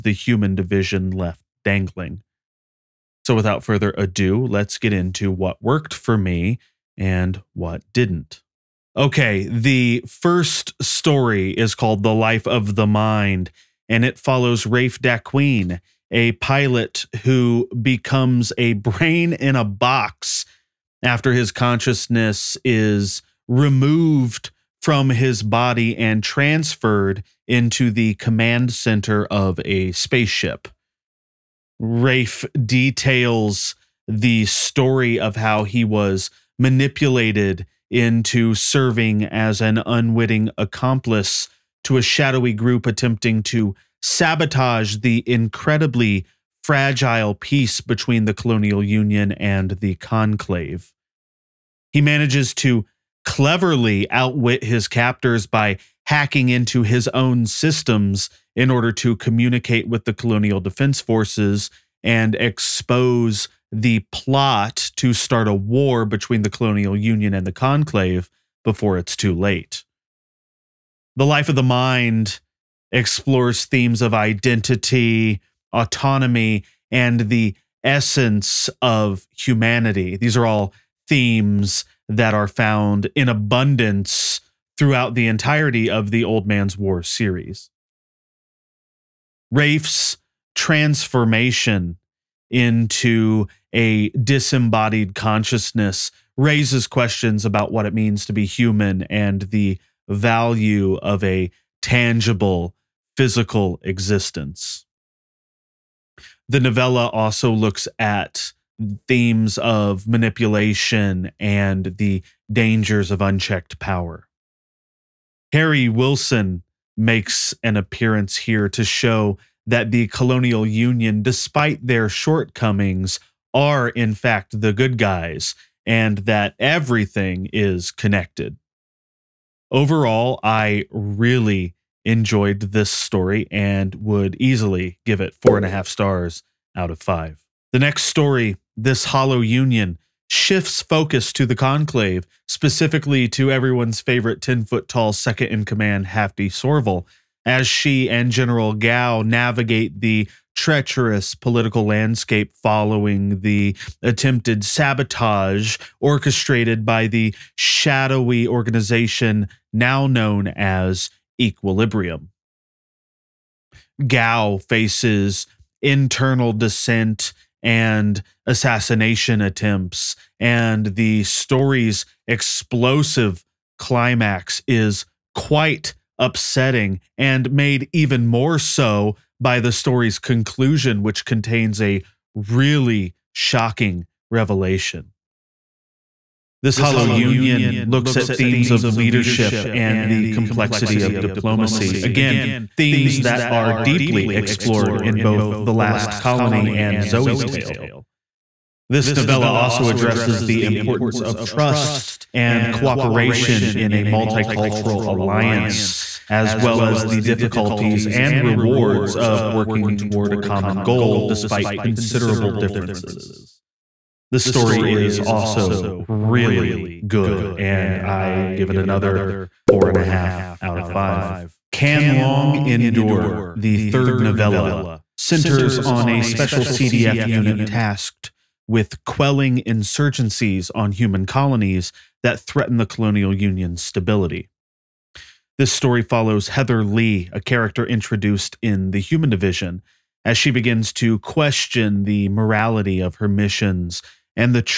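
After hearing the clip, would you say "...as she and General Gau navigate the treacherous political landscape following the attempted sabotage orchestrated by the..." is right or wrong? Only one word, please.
right.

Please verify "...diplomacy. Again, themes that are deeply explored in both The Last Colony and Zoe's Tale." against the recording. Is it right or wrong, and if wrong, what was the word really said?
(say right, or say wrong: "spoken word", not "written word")
right.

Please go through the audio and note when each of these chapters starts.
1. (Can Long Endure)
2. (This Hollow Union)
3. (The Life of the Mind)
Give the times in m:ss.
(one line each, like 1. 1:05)
1. 3:40
2. 2:16
3. 0:08.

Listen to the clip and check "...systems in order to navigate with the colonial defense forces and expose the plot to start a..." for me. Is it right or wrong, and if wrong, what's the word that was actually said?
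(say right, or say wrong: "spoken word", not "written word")
wrong: "communicate", not "navigate".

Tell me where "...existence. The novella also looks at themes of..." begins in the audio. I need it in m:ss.
1:43.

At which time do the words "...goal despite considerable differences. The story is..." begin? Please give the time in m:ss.
3:30.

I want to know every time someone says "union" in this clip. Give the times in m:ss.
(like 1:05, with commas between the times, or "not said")
0:48, 1:06, 2:00, 2:19, 3:07, 3:53.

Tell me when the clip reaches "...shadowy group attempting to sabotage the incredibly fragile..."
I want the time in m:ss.
0:42.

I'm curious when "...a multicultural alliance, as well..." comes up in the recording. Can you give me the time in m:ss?
3:23.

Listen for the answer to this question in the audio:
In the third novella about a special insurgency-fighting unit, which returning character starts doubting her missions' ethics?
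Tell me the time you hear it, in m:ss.
3:56.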